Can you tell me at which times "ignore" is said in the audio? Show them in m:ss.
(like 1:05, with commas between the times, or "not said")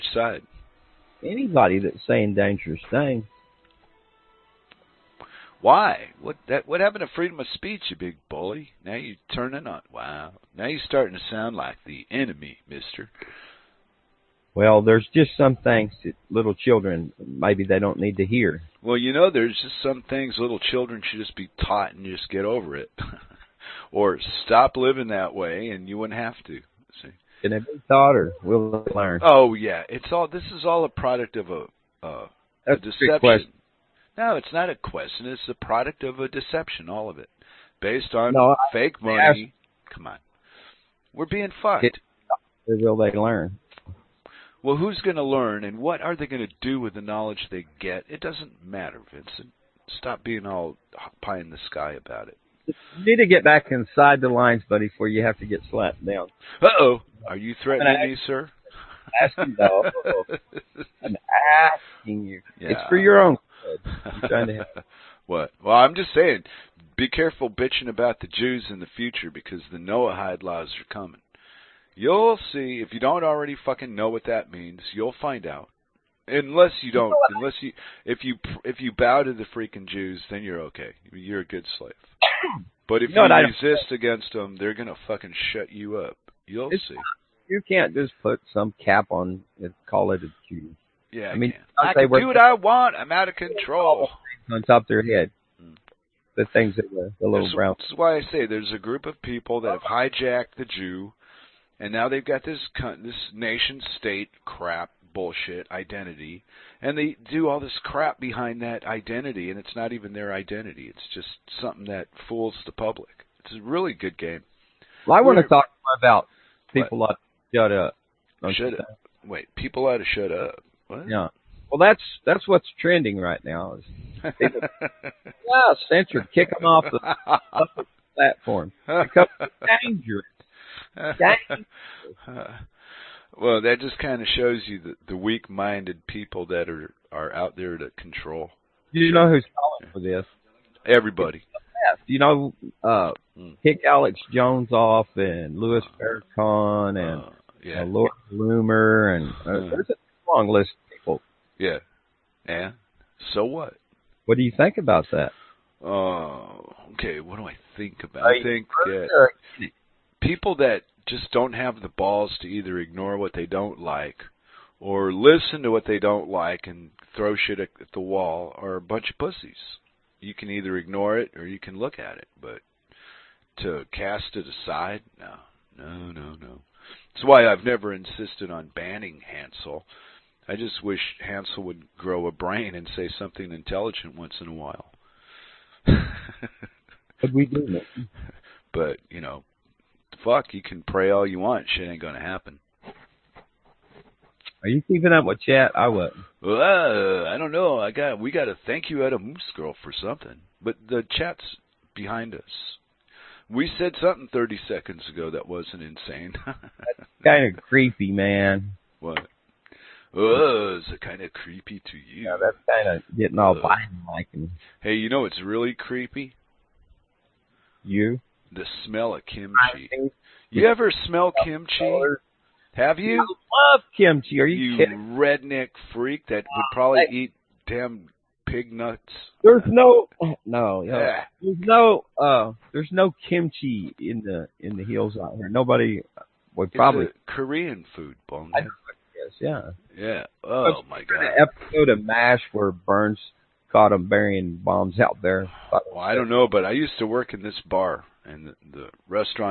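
2:42, 2:50.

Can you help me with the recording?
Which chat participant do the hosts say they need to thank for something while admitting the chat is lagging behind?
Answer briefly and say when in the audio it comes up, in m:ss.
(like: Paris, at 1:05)
Moose Girl, at 3:19.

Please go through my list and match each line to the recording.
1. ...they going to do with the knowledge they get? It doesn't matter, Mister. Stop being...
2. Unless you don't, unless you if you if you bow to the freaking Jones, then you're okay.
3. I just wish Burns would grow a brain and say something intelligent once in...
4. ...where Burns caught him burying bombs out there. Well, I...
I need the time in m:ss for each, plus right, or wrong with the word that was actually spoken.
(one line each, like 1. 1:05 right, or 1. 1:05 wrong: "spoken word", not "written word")
1. 0:46 wrong: "Vincent", not "Mister"
2. 1:16 wrong: "Jews", not "Jones"
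3. 3:00 wrong: "Hansel", not "Burns"
4. 4:02 right.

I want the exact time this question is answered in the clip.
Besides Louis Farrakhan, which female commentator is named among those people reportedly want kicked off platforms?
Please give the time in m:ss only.
2:27.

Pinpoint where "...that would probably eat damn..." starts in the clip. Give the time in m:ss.
3:46.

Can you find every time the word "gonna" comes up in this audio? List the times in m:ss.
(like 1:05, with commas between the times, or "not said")
1:24, 3:12.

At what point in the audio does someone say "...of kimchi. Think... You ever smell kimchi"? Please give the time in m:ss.
3:39.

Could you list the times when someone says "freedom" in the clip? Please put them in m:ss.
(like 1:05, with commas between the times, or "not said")
0:07.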